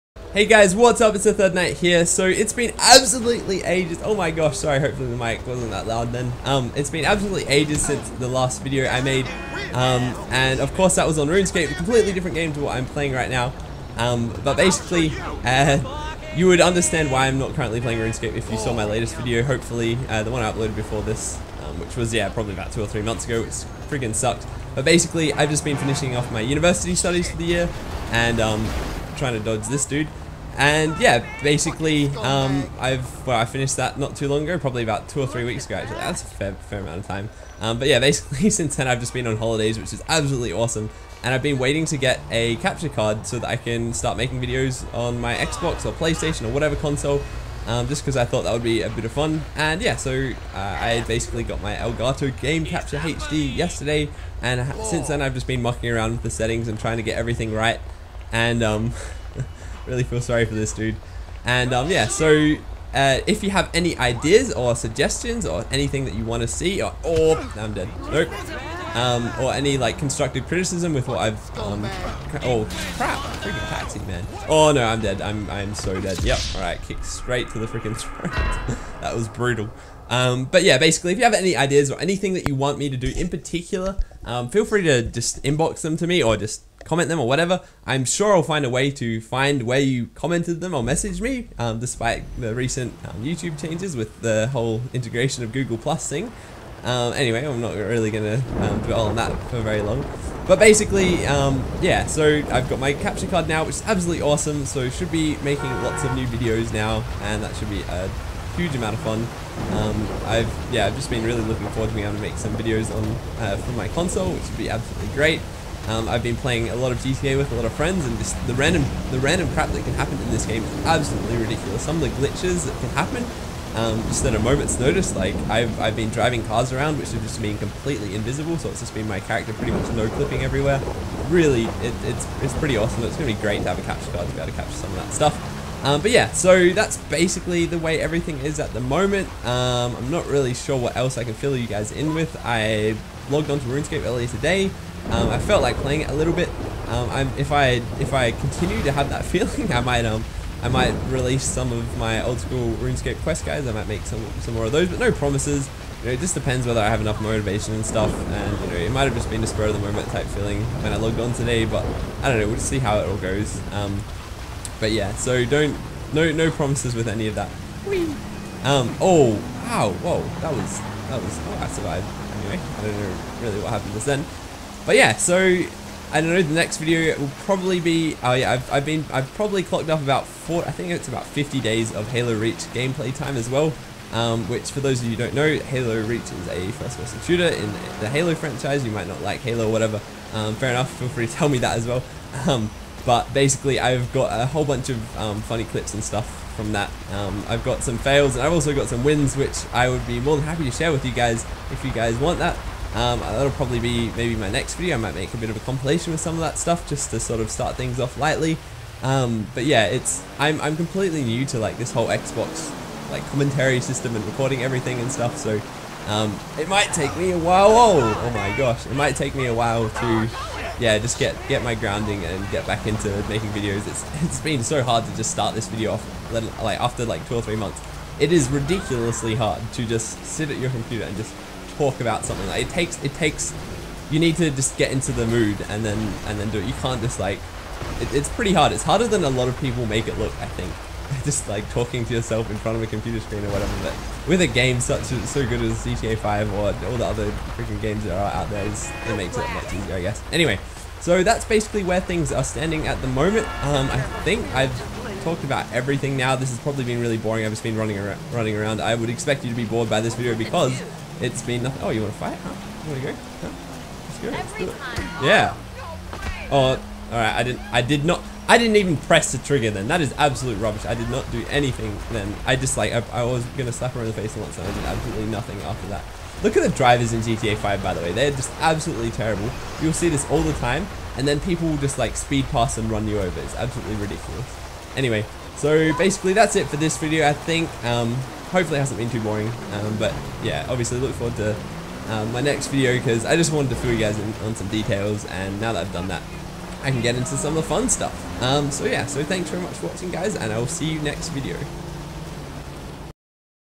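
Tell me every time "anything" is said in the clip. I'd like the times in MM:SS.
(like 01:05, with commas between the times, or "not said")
01:05, 01:22, 04:31.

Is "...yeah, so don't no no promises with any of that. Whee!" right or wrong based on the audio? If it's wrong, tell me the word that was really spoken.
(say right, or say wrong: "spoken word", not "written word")
right.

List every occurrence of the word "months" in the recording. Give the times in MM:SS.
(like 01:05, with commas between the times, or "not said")
00:23, 03:47.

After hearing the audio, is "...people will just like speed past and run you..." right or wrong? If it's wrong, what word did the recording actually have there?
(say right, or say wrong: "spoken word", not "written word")
right.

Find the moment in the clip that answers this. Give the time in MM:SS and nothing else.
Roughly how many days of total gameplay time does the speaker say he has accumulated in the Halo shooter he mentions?
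03:01.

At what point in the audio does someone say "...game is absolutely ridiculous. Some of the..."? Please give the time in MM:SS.
02:00.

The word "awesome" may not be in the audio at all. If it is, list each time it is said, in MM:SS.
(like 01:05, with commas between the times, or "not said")
00:40, 01:44, 02:12.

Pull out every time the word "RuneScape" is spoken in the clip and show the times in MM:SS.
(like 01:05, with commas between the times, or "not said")
00:11, 00:17, 02:23, 02:32.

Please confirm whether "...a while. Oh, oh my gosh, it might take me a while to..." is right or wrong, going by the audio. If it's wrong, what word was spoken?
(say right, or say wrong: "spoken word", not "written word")
right.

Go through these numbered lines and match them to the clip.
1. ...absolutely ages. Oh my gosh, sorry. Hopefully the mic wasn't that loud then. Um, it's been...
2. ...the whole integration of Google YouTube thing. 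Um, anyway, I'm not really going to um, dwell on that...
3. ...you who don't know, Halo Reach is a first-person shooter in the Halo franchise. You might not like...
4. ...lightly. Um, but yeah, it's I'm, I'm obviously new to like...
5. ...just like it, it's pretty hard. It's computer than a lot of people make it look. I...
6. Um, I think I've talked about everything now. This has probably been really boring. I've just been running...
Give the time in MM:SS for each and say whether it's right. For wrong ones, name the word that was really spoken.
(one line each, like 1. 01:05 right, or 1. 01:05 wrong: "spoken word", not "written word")
1. 00:02 right
2. 01:34 wrong: "Plus", not "YouTube"
3. 03:05 right
4. 03:28 wrong: "completely", not "obviously"
5. 03:57 wrong: "harder", not "computer"
6. 04:13 right.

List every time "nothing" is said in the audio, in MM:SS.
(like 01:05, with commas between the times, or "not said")
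04:21, 04:35.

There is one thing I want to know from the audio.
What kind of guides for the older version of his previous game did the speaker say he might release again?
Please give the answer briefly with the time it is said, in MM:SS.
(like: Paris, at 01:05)
quest guides, at 02:33.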